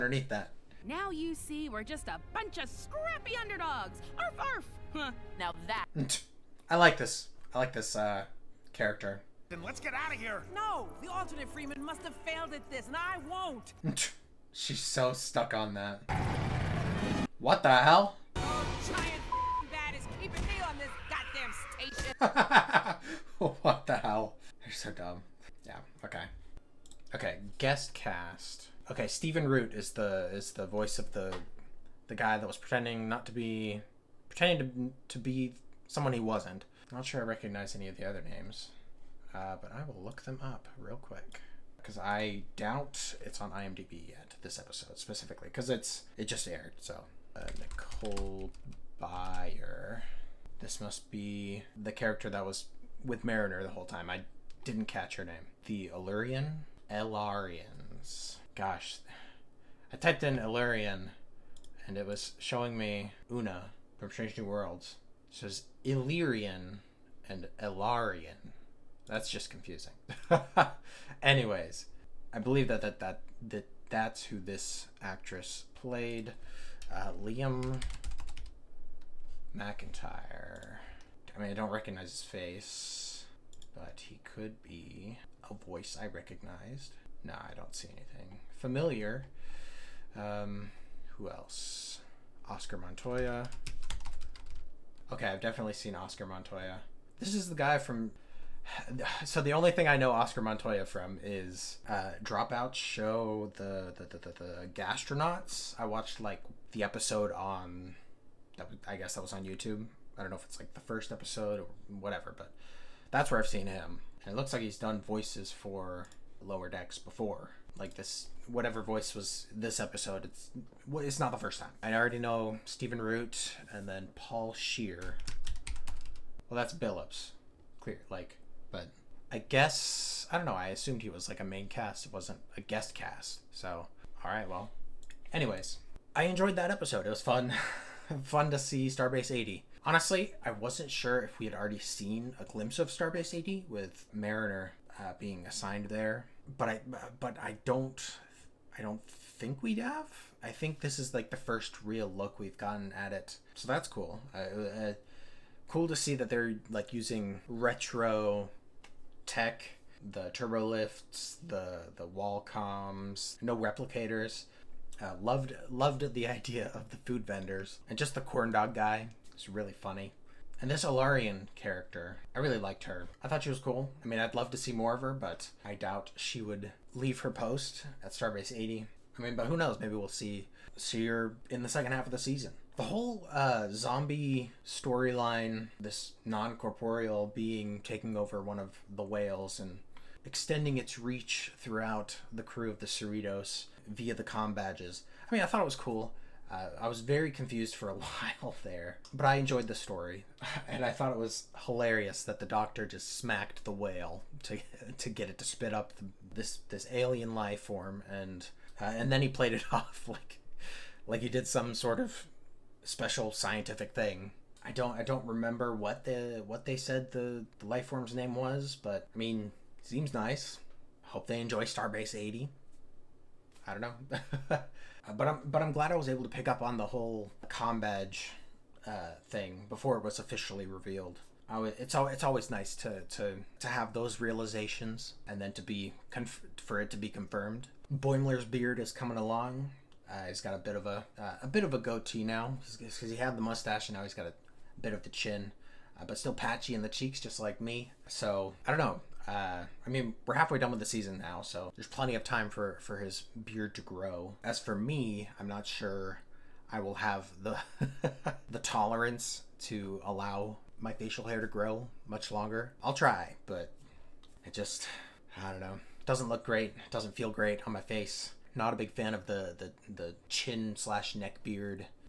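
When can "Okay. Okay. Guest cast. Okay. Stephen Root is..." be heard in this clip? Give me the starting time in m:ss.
0:26.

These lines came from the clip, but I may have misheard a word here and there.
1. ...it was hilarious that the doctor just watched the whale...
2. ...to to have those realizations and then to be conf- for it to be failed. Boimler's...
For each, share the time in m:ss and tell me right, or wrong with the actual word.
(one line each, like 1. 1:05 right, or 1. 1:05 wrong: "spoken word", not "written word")
1. 3:21 wrong: "smacked", not "watched"
2. 3:53 wrong: "confirmed", not "failed".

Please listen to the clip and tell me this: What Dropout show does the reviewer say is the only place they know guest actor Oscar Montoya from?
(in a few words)
Gastronauts.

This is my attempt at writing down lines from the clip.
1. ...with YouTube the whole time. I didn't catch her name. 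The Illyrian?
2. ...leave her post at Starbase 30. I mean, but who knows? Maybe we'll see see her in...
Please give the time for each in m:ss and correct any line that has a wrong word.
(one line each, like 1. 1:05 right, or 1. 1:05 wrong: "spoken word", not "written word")
1. 0:53 wrong: "Mariner", not "YouTube"
2. 2:56 wrong: "80", not "30".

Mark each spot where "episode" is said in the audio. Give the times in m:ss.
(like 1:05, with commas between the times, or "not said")
0:44, 1:46, 1:51, 1:59, 2:16.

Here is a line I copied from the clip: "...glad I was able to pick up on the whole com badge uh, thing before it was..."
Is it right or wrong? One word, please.
right.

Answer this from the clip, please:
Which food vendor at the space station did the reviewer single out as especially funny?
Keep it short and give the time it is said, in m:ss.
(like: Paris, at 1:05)
the corn dog guy, at 2:48.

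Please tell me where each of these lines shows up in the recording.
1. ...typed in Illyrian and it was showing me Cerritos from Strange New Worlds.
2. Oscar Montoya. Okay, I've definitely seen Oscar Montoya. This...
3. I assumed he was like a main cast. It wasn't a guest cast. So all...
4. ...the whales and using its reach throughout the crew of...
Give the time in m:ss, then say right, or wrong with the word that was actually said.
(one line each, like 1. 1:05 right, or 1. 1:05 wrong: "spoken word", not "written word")
1. 0:59 wrong: "Una", not "Cerritos"
2. 1:32 right
3. 2:10 right
4. 3:08 wrong: "extending", not "using".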